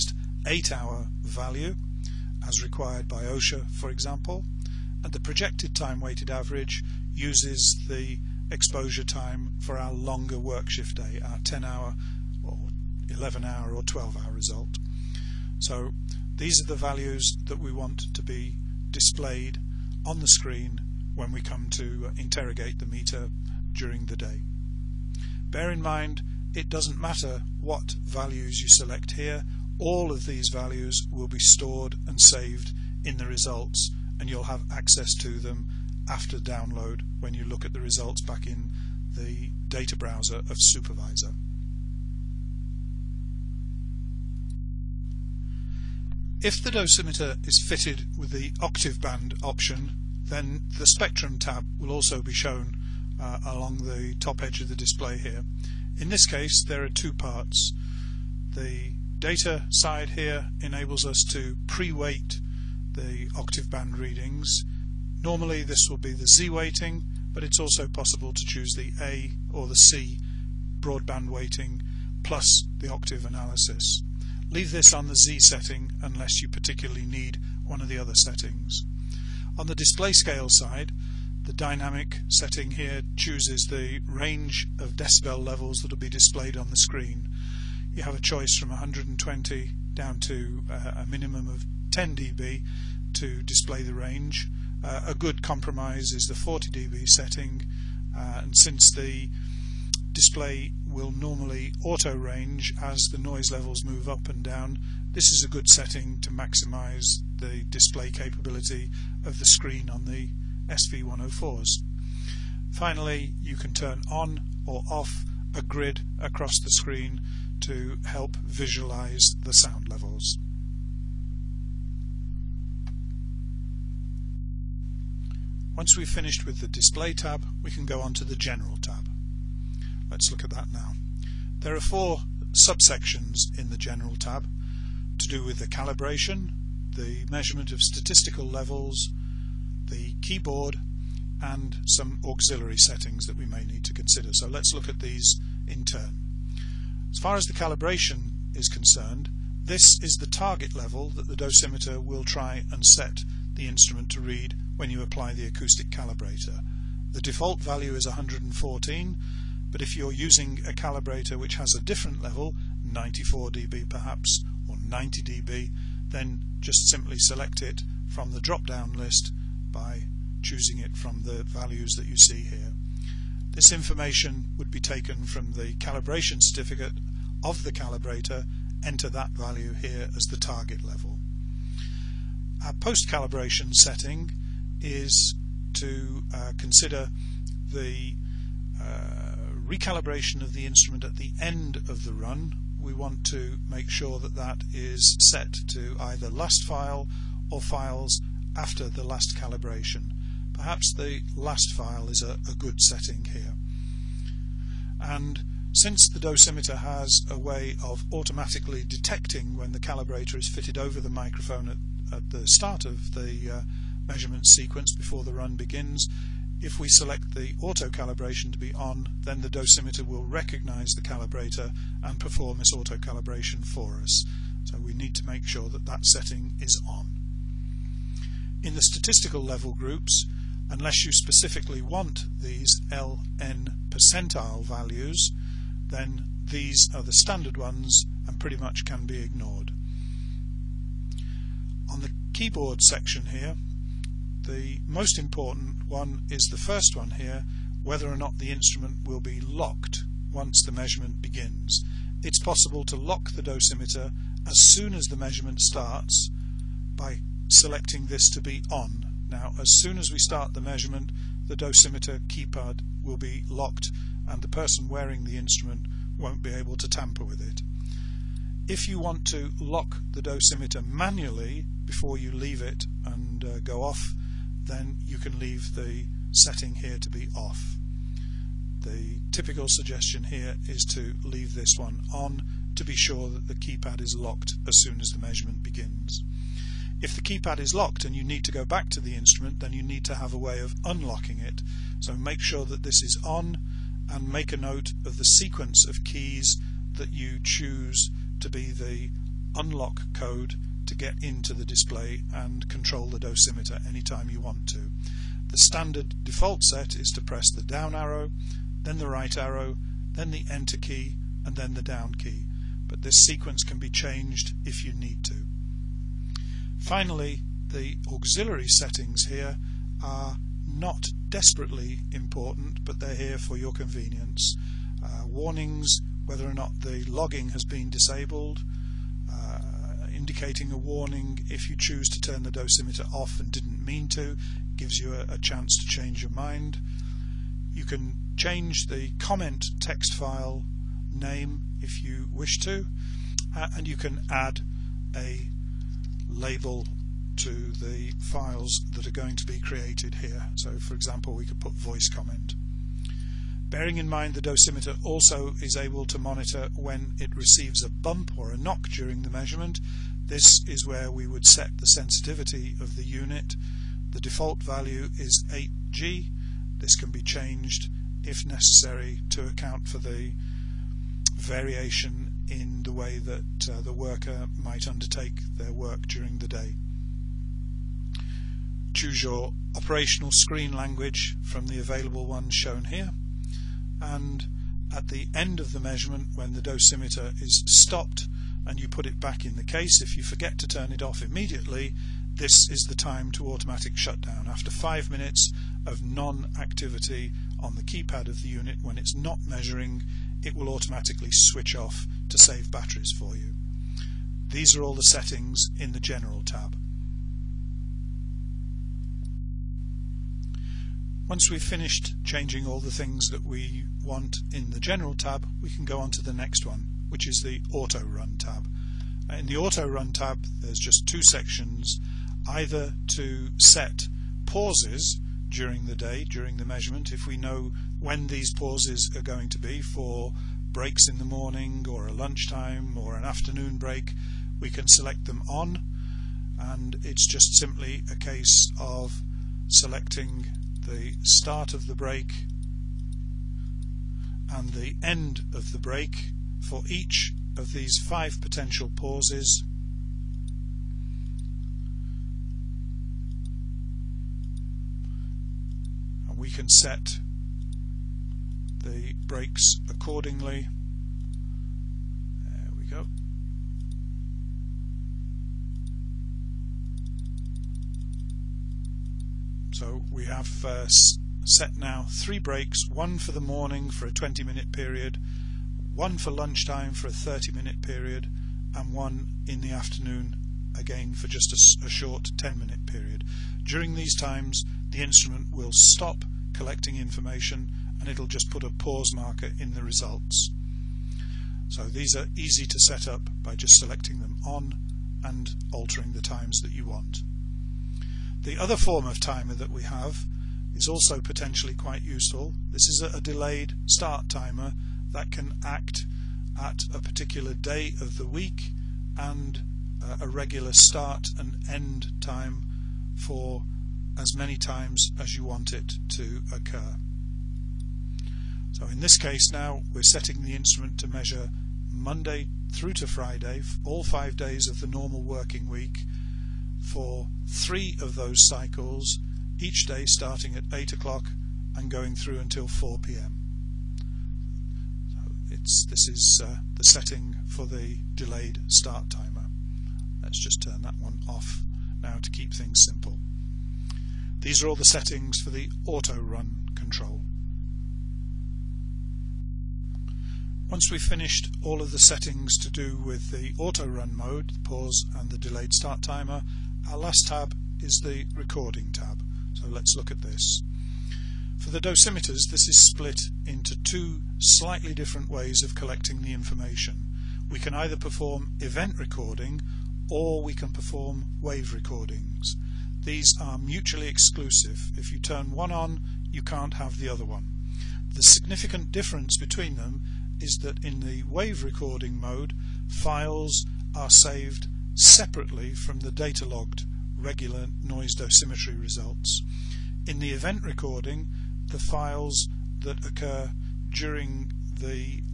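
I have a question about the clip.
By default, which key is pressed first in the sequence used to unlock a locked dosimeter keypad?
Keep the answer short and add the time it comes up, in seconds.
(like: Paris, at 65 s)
Down arrow, at 307 s.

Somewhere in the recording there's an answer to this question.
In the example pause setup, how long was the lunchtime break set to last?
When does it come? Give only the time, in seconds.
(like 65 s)
477 s.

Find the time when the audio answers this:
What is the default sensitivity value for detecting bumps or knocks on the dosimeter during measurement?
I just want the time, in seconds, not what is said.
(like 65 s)
365 s.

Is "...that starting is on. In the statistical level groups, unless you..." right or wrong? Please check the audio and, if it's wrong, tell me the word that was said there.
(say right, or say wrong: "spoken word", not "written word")
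wrong: "setting", not "starting".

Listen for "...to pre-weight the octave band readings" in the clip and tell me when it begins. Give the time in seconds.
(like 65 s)
61 s.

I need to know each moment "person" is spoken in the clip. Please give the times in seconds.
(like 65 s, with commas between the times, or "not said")
264 s.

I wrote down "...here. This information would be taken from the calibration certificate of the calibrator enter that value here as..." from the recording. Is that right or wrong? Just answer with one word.
right.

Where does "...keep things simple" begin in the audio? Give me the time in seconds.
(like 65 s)
542 s.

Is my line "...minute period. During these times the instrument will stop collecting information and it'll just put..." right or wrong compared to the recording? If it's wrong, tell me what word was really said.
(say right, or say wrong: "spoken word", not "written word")
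right.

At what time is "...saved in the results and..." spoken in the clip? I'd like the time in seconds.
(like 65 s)
32 s.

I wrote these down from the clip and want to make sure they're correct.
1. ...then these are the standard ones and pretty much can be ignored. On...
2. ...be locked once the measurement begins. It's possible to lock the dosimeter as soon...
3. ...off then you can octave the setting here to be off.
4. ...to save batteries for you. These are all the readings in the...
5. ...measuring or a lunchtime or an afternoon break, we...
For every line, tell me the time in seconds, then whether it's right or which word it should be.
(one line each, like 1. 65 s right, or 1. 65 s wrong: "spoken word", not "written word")
1. 235 s right
2. 249 s right
3. 273 s wrong: "leave", not "octave"
4. 402 s wrong: "settings", not "readings"
5. 431 s wrong: "morning", not "measuring".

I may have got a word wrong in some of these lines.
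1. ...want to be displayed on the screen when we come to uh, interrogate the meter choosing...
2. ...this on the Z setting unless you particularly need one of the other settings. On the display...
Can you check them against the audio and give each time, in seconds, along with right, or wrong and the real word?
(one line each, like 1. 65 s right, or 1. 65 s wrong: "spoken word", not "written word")
1. 17 s wrong: "during", not "choosing"
2. 74 s right.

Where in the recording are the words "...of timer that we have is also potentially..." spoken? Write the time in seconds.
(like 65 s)
499 s.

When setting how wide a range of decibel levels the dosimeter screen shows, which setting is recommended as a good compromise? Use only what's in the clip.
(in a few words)
40 dB.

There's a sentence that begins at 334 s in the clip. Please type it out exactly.
Gives you a, a chance to change your mind.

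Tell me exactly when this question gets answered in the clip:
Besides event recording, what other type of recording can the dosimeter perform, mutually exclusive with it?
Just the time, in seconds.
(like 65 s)
571 s.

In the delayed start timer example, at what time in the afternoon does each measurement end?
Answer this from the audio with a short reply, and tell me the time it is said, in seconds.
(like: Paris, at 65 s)
4 p.m., at 532 s.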